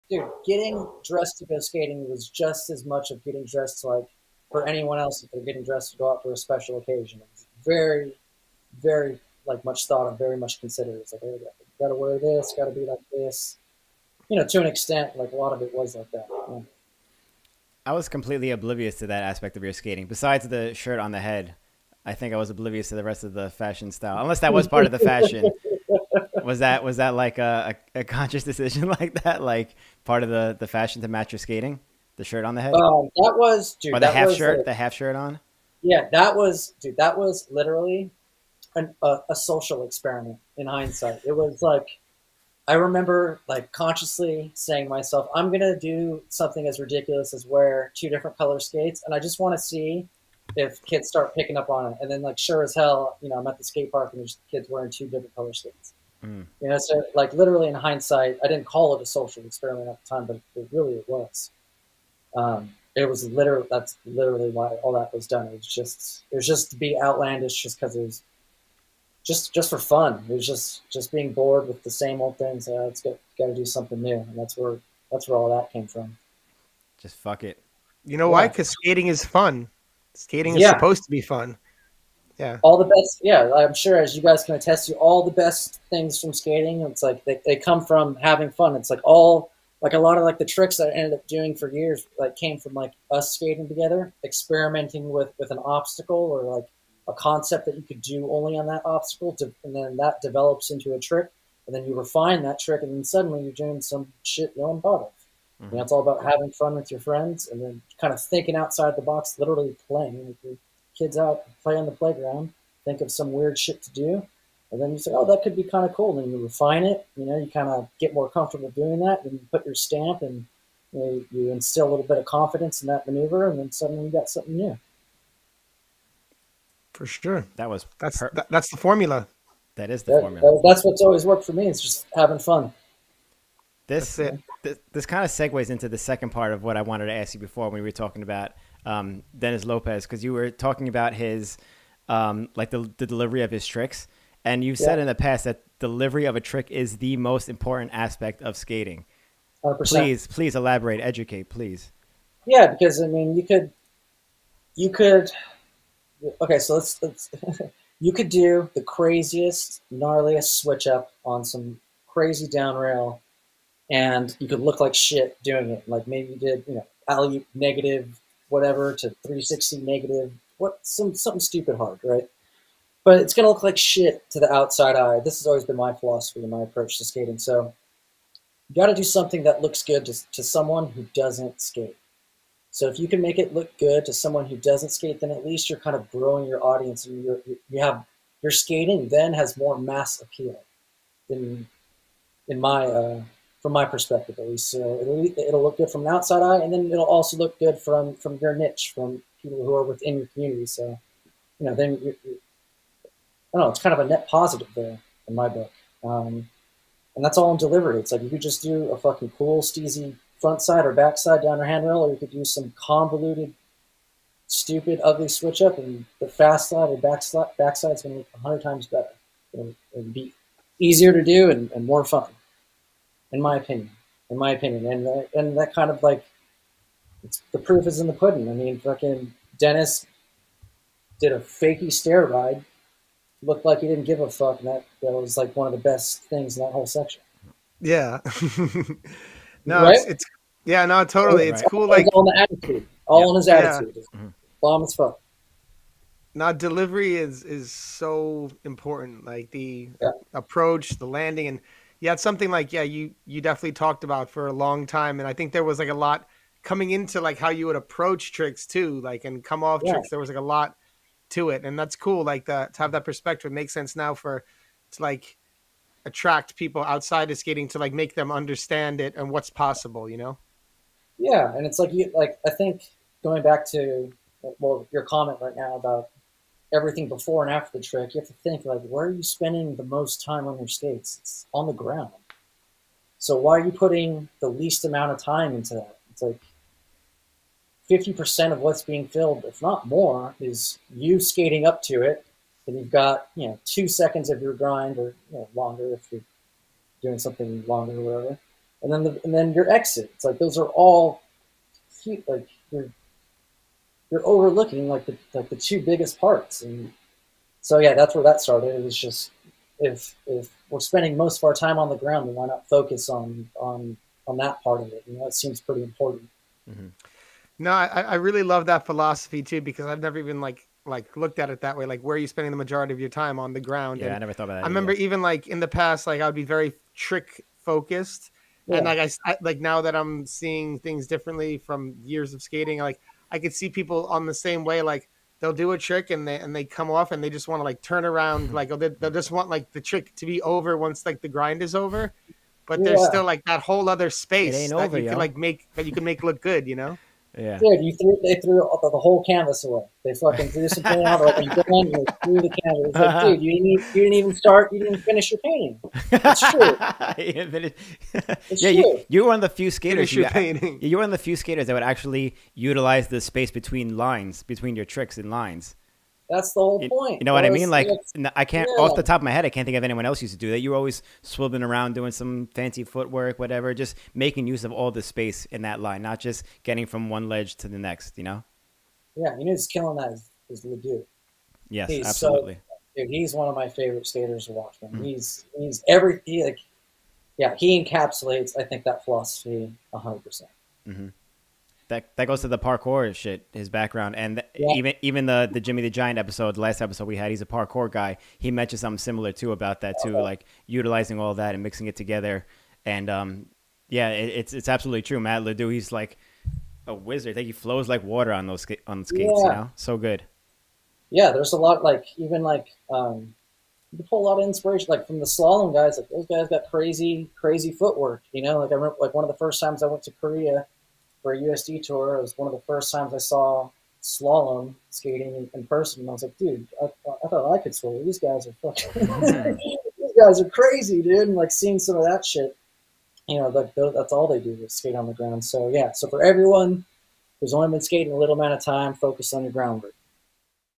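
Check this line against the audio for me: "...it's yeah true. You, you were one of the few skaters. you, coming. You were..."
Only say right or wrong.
wrong.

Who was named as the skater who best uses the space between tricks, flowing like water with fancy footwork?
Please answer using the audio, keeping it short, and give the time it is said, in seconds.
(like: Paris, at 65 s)
Matt Ledoux, at 405 s.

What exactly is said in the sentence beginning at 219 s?
It'll, be easier to do and, and more fun in my opinion.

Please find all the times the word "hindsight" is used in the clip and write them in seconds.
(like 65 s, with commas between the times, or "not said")
40 s, 57 s.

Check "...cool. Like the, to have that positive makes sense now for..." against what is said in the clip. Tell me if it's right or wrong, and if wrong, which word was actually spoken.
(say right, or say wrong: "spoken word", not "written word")
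wrong: "perspective", not "positive".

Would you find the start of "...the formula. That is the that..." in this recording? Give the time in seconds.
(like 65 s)
128 s.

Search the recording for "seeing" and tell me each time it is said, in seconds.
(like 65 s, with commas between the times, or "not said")
330 s, 431 s.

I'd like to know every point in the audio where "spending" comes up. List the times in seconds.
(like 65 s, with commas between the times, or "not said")
279 s, 310 s, 322 s.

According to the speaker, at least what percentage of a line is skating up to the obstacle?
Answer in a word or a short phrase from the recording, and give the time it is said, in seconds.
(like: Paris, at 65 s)
50%, at 287 s.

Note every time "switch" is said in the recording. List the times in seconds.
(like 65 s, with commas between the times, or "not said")
160 s, 215 s.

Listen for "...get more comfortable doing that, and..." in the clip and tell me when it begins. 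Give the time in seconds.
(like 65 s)
117 s.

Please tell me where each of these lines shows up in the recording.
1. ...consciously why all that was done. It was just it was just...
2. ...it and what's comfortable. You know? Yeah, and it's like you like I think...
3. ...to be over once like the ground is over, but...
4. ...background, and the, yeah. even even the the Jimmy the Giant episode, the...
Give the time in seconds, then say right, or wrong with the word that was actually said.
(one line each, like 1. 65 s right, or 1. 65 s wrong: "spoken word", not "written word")
1. 64 s wrong: "literally", not "consciously"
2. 268 s wrong: "possible", not "comfortable"
3. 340 s wrong: "grind", not "ground"
4. 393 s right.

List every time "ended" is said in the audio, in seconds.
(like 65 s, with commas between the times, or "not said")
90 s.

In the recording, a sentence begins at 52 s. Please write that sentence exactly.
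And then like sure as hell, you know, I'm at the skate park and there's kids wearing two different color skates.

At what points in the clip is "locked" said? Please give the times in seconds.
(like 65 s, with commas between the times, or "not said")
not said.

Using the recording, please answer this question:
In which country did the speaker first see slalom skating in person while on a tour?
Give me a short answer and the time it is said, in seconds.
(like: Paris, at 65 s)
Korea, at 420 s.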